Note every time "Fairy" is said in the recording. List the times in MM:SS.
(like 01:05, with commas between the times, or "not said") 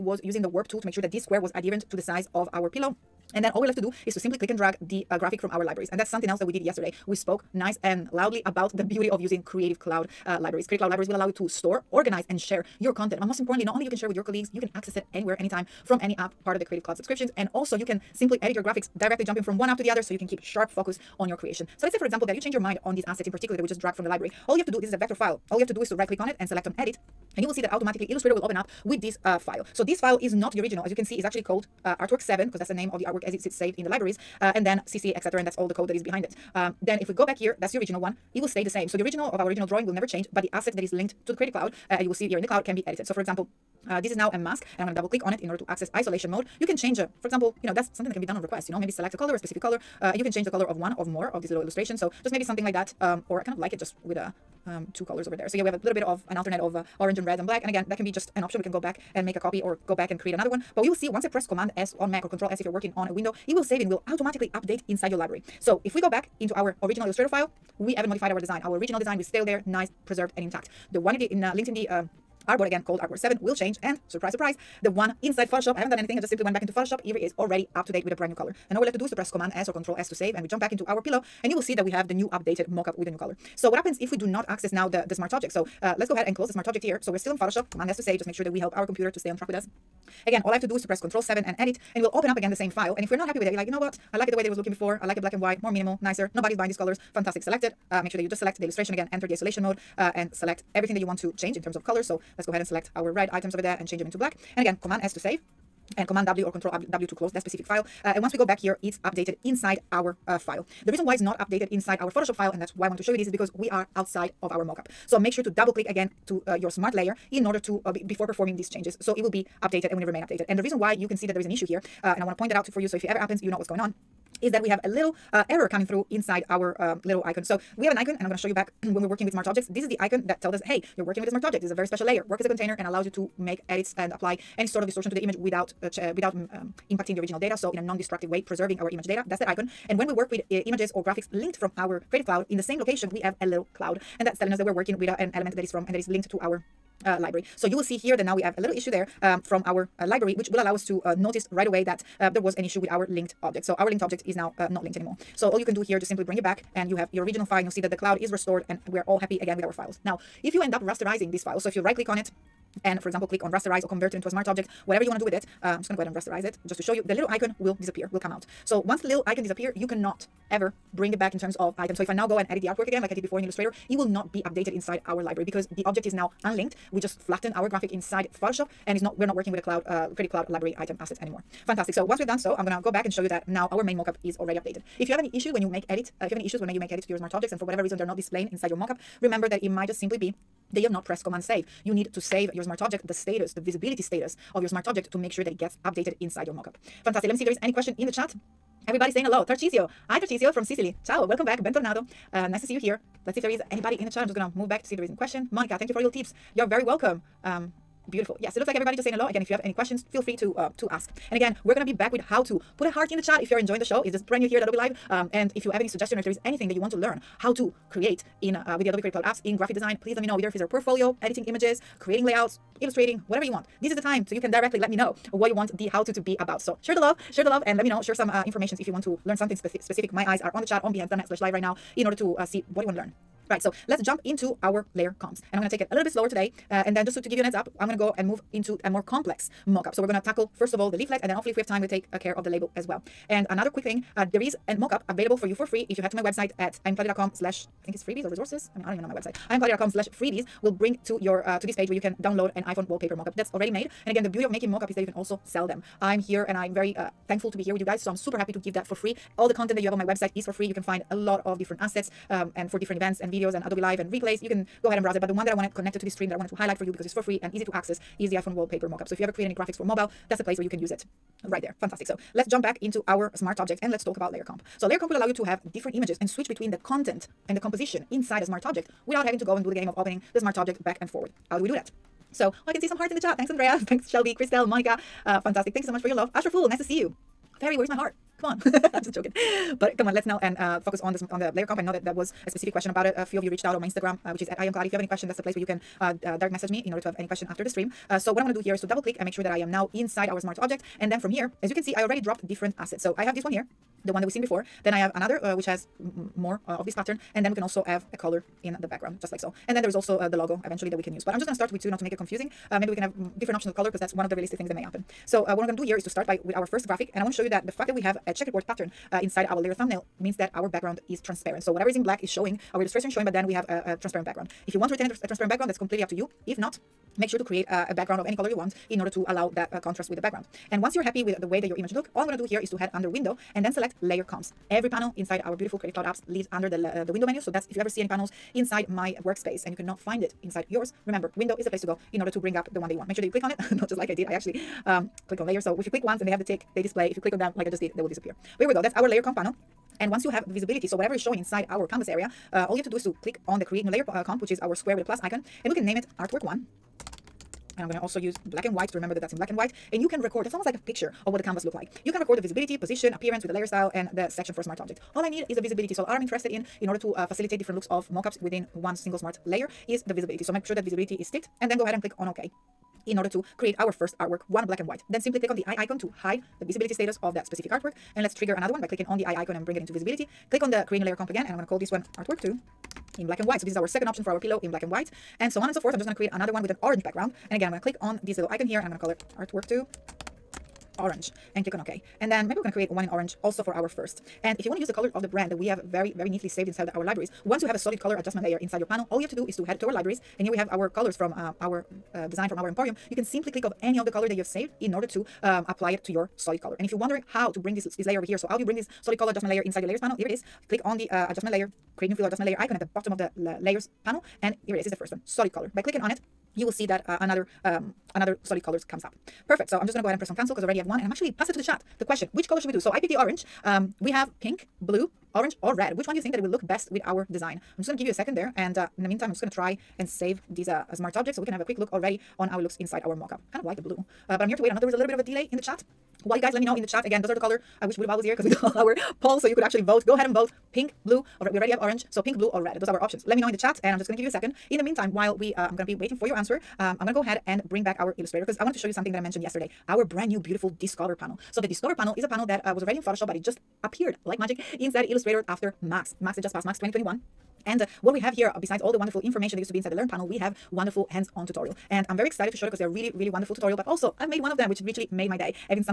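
04:47.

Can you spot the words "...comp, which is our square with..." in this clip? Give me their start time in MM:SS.
05:54.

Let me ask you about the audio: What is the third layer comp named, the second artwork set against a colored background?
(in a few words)
Artwork 2 orange.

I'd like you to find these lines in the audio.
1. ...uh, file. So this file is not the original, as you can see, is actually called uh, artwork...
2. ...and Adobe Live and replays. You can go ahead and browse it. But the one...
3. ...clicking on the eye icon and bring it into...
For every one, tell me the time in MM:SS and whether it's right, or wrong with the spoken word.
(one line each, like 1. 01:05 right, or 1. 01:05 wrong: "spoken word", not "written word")
1. 00:29 right
2. 04:23 right
3. 06:18 right.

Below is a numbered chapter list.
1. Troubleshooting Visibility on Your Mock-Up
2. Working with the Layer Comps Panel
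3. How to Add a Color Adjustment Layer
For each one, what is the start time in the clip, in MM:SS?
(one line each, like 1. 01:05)
1. 03:06
2. 05:35
3. 06:49.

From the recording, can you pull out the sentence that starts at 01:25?
So uh, let's go ahead and close the smart object here.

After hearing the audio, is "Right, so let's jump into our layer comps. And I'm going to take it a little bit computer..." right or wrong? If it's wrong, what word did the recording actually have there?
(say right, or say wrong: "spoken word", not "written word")
wrong: "slower", not "computer".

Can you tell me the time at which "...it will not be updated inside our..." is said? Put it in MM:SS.
02:53.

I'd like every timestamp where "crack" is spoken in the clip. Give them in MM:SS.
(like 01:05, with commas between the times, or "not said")
not said.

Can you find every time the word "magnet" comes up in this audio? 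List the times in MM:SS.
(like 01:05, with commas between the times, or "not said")
not said.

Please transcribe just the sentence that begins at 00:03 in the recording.
And then all we're left to do is to simply click and drag the uh, graphic from our libraries.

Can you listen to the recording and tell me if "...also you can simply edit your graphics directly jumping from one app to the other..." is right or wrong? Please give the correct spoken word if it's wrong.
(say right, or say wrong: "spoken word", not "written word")
right.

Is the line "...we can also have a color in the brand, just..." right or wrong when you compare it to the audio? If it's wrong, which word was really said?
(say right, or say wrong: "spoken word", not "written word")
wrong: "background", not "brand".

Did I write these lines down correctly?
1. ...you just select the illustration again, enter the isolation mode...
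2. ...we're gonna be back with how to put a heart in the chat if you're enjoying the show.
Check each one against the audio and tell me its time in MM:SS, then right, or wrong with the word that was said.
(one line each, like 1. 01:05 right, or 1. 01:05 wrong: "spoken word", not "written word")
1. 01:38 right
2. 03:31 right.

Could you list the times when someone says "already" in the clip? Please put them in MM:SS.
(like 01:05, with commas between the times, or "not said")
01:17, 03:04, 04:13, 05:02, 07:00, 07:11, 07:21, 07:32.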